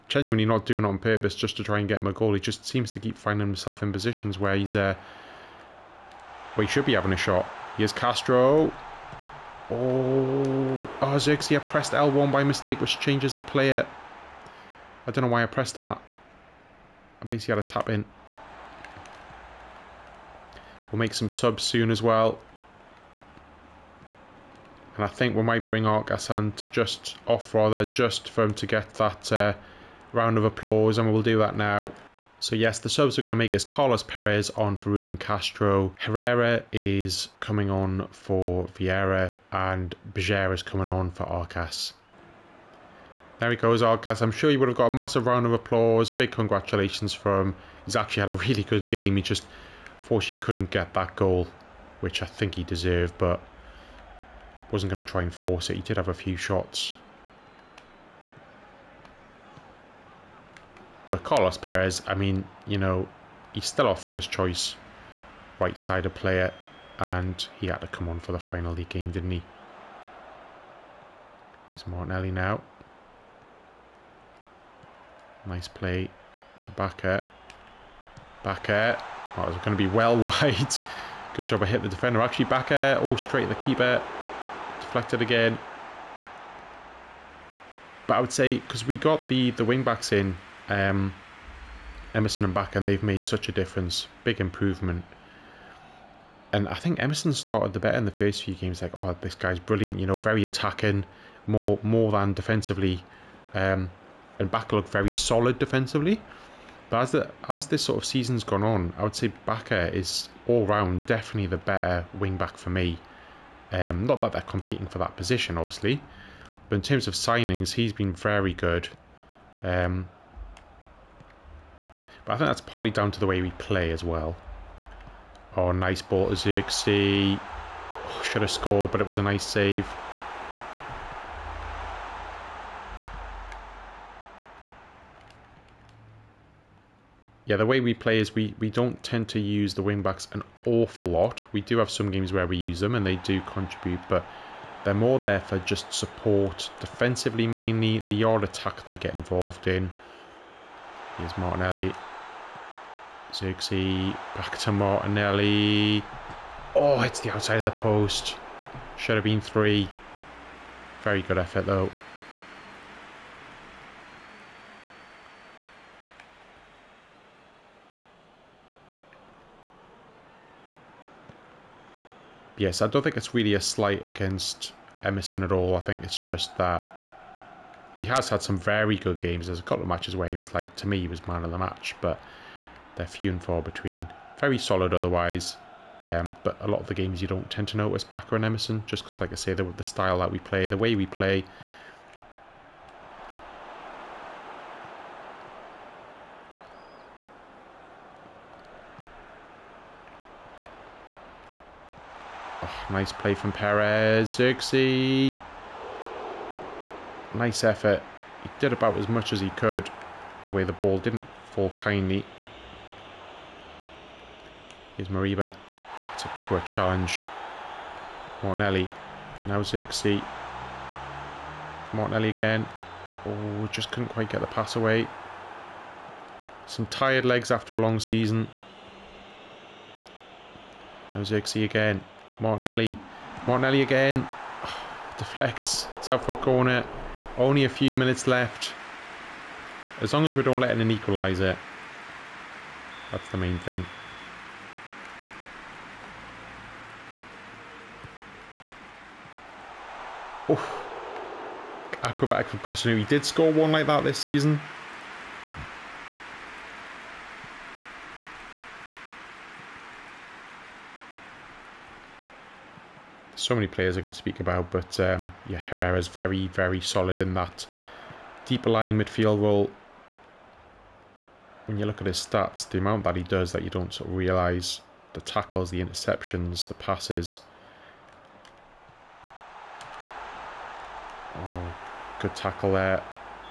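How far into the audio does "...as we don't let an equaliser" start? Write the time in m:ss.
4:00.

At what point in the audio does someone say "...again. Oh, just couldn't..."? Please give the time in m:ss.
3:42.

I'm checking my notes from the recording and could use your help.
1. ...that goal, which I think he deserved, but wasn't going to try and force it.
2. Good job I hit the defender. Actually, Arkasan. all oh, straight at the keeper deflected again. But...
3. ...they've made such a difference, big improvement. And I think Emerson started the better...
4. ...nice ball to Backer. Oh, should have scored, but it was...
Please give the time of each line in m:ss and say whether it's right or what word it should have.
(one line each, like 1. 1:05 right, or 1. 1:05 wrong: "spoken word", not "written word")
1. 0:50 right
2. 1:21 wrong: "Backer", not "Arkasan"
3. 1:32 right
4. 2:05 wrong: "Zirkzee", not "Backer".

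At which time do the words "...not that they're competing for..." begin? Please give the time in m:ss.
1:54.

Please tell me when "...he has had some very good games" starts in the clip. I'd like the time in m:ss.
2:57.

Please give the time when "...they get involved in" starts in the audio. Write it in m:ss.
2:28.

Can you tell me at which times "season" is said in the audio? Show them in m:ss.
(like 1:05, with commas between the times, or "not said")
1:48, 3:48, 4:14.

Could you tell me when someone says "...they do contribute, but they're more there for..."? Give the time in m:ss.
2:23.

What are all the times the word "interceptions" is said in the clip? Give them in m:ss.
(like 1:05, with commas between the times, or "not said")
4:35.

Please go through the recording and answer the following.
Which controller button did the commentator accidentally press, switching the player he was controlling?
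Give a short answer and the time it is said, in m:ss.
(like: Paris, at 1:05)
L1, at 0:11.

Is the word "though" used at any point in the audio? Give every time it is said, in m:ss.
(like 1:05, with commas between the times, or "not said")
2:41.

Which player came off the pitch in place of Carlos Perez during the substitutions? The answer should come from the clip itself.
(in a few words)
Ruben Castro.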